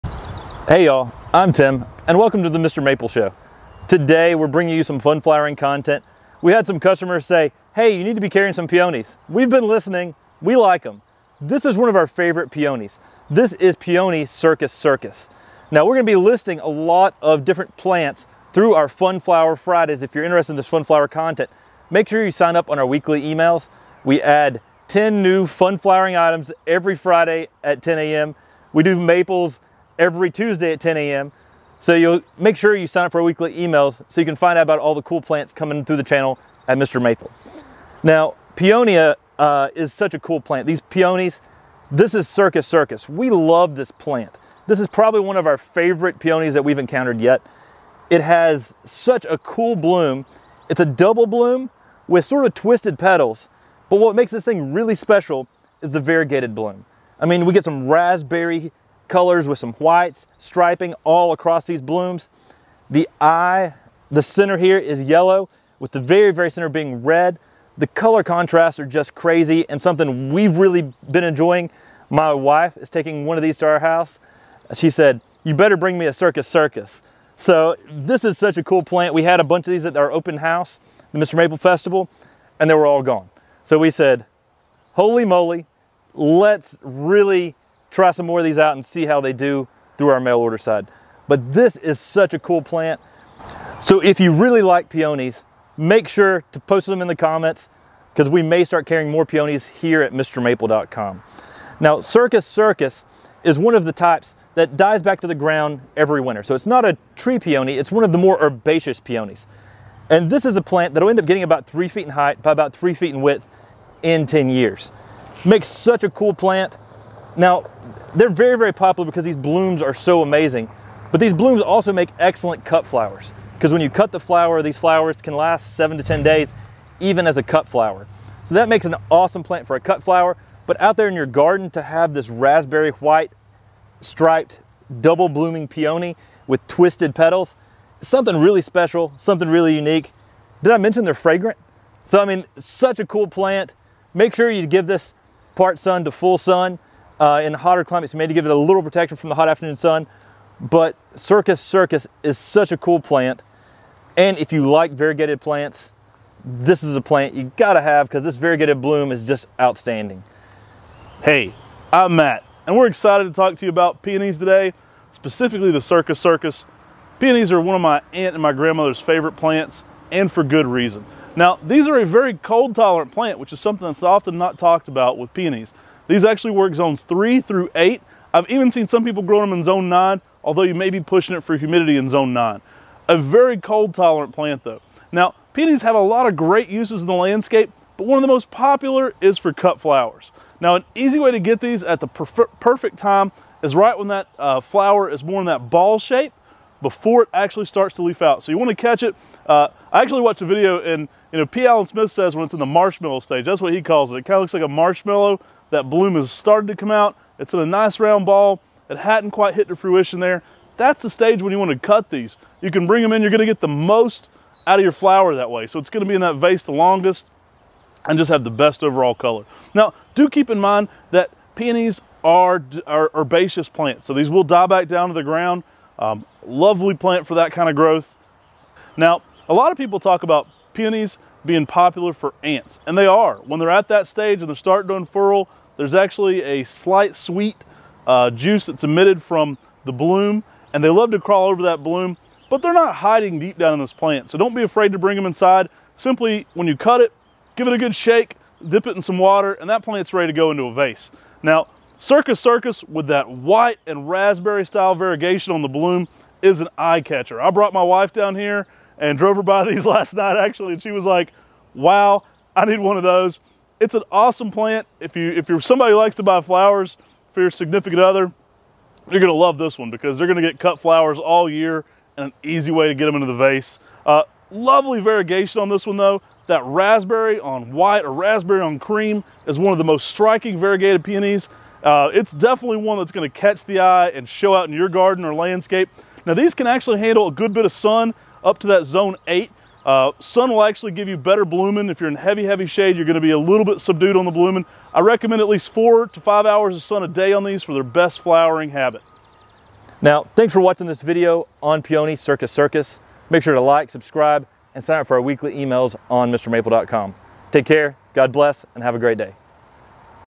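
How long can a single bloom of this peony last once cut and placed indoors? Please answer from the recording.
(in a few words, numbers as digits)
7 to 10 days.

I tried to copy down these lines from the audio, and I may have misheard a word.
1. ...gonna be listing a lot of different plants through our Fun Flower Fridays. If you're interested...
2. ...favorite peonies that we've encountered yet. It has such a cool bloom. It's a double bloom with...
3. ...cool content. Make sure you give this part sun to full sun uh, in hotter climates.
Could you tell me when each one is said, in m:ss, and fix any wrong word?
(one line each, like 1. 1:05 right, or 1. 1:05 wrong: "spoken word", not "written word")
1. 0:15 right
2. 0:45 right
3. 2:23 wrong: "plant", not "content".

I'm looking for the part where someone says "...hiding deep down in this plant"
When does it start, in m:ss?
4:02.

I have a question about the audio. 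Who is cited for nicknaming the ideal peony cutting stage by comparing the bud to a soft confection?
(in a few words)
P. Allen Smith.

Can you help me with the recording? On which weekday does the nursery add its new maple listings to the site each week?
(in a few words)
Tuesday.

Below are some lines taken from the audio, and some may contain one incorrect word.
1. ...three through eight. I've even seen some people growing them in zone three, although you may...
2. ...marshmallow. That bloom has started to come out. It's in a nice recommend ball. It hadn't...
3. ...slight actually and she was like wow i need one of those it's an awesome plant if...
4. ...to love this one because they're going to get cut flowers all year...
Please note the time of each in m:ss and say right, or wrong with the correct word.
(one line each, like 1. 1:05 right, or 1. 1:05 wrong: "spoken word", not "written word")
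1. 2:57 wrong: "nine", not "three"
2. 3:24 wrong: "round", not "recommend"
3. 4:20 wrong: "night", not "slight"
4. 4:29 right.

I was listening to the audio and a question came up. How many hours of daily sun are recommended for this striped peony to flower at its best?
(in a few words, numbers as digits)
4 to 5 hours.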